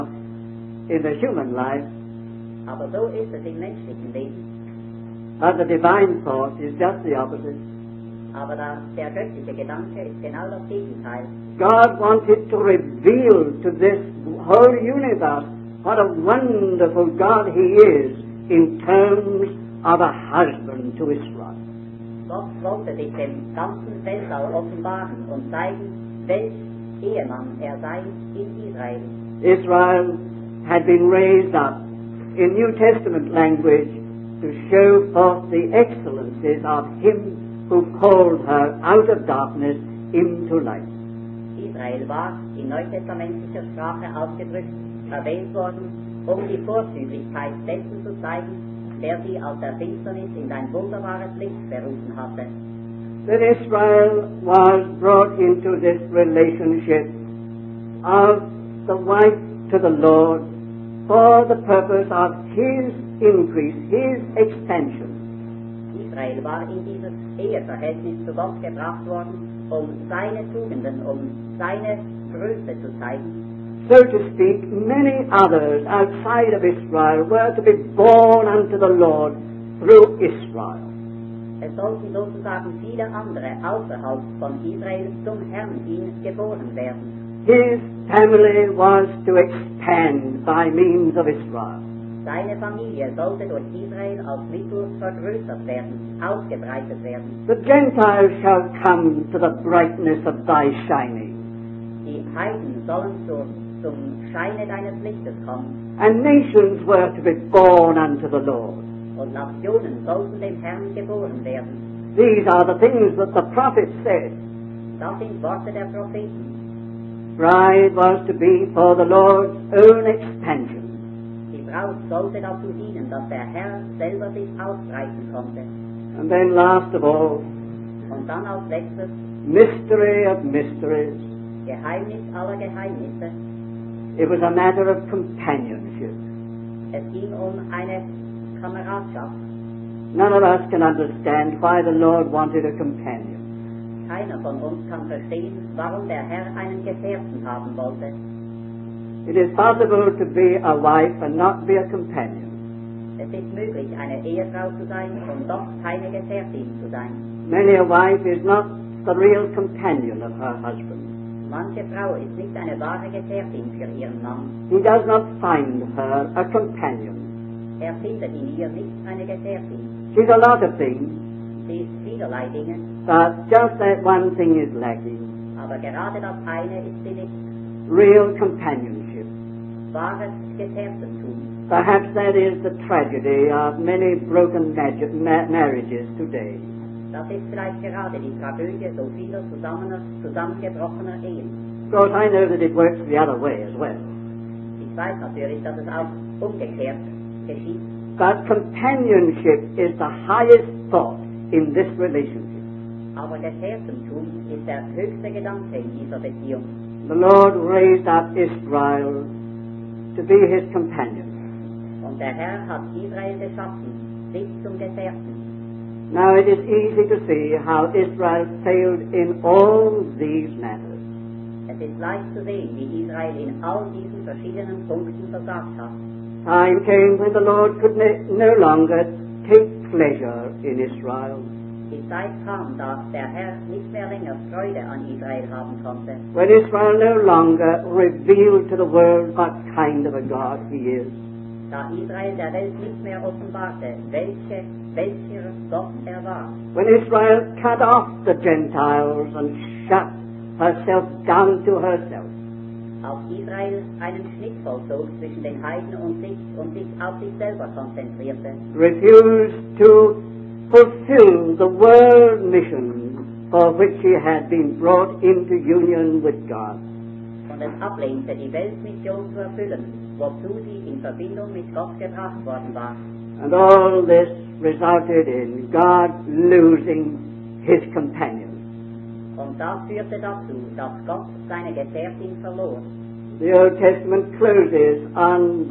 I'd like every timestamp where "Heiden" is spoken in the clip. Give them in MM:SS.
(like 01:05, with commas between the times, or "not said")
01:42, 04:15.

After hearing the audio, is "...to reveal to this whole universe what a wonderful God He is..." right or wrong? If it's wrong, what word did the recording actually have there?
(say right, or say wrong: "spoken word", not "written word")
right.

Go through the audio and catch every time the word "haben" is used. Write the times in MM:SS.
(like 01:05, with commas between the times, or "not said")
02:27, 03:55.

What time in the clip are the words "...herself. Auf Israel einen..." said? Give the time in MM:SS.
04:11.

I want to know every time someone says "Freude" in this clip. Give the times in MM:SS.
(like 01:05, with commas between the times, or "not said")
03:54.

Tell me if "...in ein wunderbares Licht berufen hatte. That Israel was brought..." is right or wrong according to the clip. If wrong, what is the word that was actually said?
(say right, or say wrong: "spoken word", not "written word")
right.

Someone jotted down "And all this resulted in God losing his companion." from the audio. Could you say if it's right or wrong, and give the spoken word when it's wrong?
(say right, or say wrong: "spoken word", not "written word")
right.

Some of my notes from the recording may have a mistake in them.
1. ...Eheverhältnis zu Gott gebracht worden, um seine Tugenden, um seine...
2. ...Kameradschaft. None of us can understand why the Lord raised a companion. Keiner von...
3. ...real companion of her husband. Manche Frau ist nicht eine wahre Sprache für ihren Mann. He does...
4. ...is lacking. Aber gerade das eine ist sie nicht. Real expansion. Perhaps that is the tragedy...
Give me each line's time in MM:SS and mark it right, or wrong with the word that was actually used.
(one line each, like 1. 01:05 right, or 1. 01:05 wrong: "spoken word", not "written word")
1. 01:07 right
2. 02:18 wrong: "wanted", not "raised"
3. 02:39 wrong: "Gefährtin", not "Sprache"
4. 02:54 wrong: "companion", not "expansion".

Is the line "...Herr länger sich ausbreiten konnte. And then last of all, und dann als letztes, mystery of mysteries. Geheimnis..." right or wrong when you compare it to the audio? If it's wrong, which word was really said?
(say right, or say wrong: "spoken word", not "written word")
wrong: "selber", not "länger".